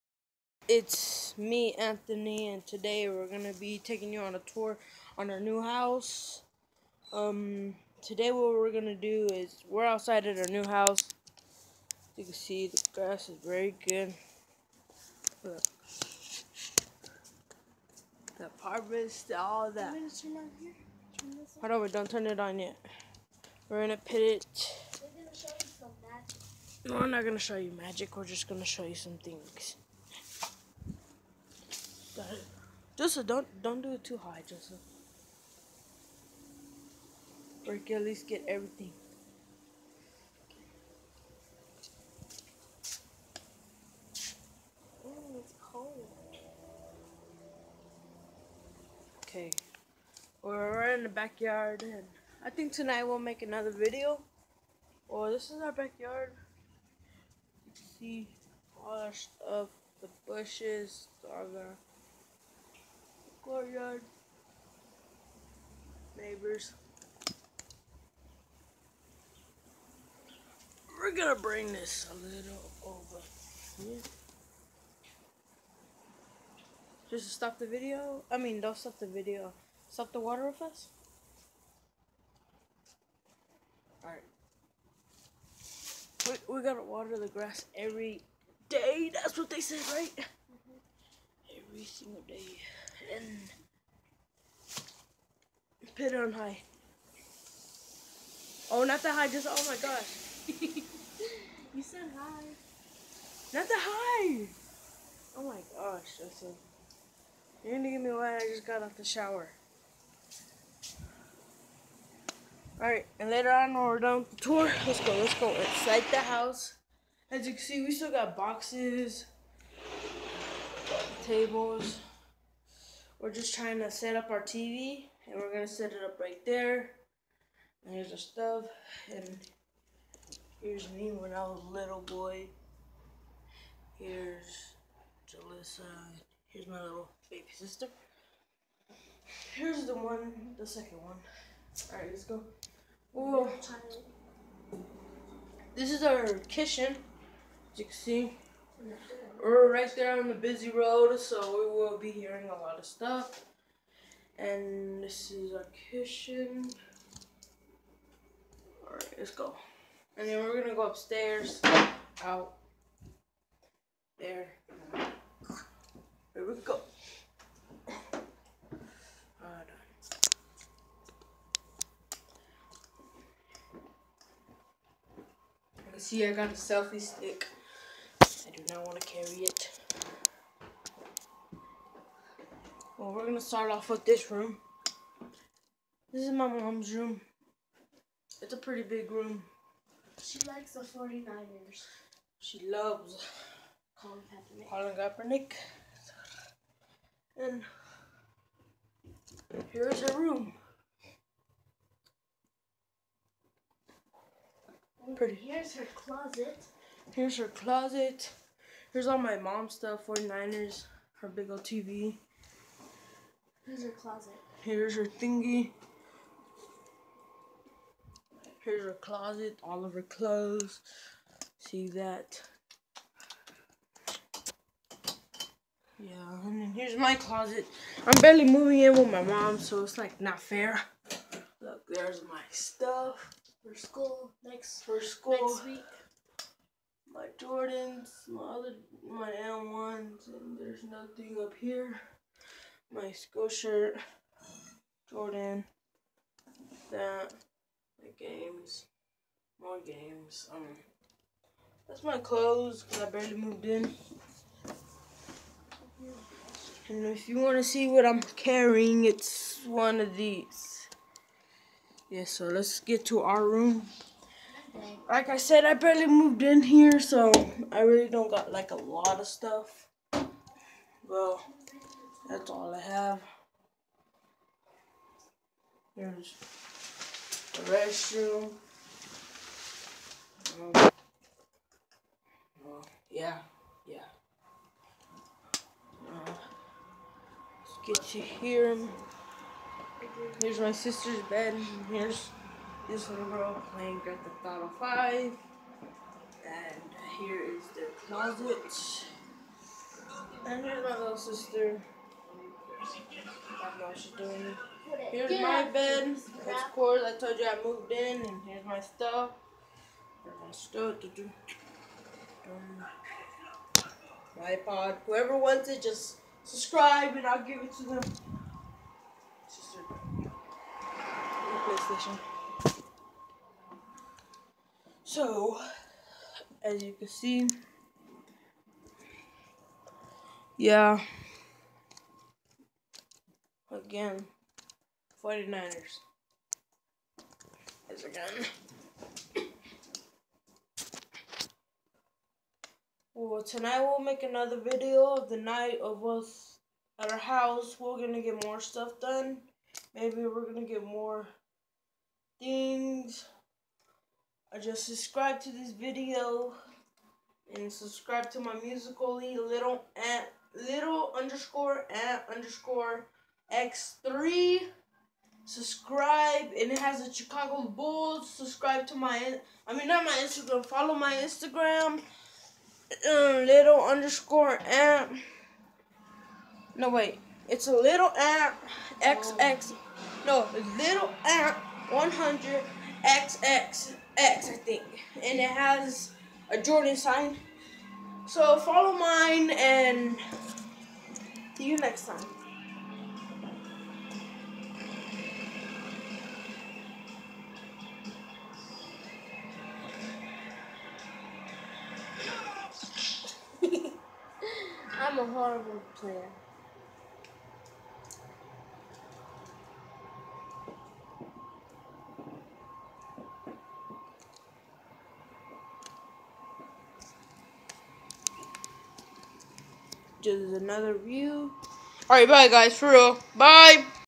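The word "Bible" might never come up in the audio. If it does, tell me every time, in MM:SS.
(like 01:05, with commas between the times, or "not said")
not said.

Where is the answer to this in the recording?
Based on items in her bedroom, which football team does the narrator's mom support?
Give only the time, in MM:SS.
03:10.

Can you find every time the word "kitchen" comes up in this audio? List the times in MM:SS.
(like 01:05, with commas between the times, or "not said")
02:26, 02:35.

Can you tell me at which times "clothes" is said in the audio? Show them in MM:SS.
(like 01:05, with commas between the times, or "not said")
03:40, 04:12.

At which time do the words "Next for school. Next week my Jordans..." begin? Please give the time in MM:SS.
03:54.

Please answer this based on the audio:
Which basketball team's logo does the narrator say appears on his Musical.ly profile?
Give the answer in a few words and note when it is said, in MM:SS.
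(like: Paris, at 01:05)
Chicago Bulls, at 06:07.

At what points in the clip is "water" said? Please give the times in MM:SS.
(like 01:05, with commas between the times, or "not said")
01:20, 01:26.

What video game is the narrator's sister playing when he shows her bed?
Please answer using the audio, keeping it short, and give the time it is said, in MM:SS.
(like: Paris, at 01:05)
Grand Theft Auto 5, at 04:54.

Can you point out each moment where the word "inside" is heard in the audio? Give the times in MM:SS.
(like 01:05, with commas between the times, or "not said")
01:55.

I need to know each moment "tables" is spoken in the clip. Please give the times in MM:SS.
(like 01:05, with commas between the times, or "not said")
02:01.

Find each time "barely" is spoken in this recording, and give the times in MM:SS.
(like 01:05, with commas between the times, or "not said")
03:48, 04:13, 04:25.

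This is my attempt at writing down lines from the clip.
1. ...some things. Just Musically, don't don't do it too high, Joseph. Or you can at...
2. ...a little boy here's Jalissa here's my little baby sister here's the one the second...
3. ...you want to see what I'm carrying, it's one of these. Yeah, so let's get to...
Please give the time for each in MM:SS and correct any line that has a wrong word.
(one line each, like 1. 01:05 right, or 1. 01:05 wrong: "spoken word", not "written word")
1. 00:28 wrong: "Joseph", not "Musically"
2. 02:11 right
3. 04:17 right.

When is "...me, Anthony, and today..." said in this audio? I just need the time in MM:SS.
00:01.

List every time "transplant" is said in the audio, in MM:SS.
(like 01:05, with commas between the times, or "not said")
not said.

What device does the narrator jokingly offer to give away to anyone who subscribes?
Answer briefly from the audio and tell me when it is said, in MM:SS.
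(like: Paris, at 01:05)
iPod, at 05:14.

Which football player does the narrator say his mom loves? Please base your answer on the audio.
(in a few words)
Colin Kaepernick.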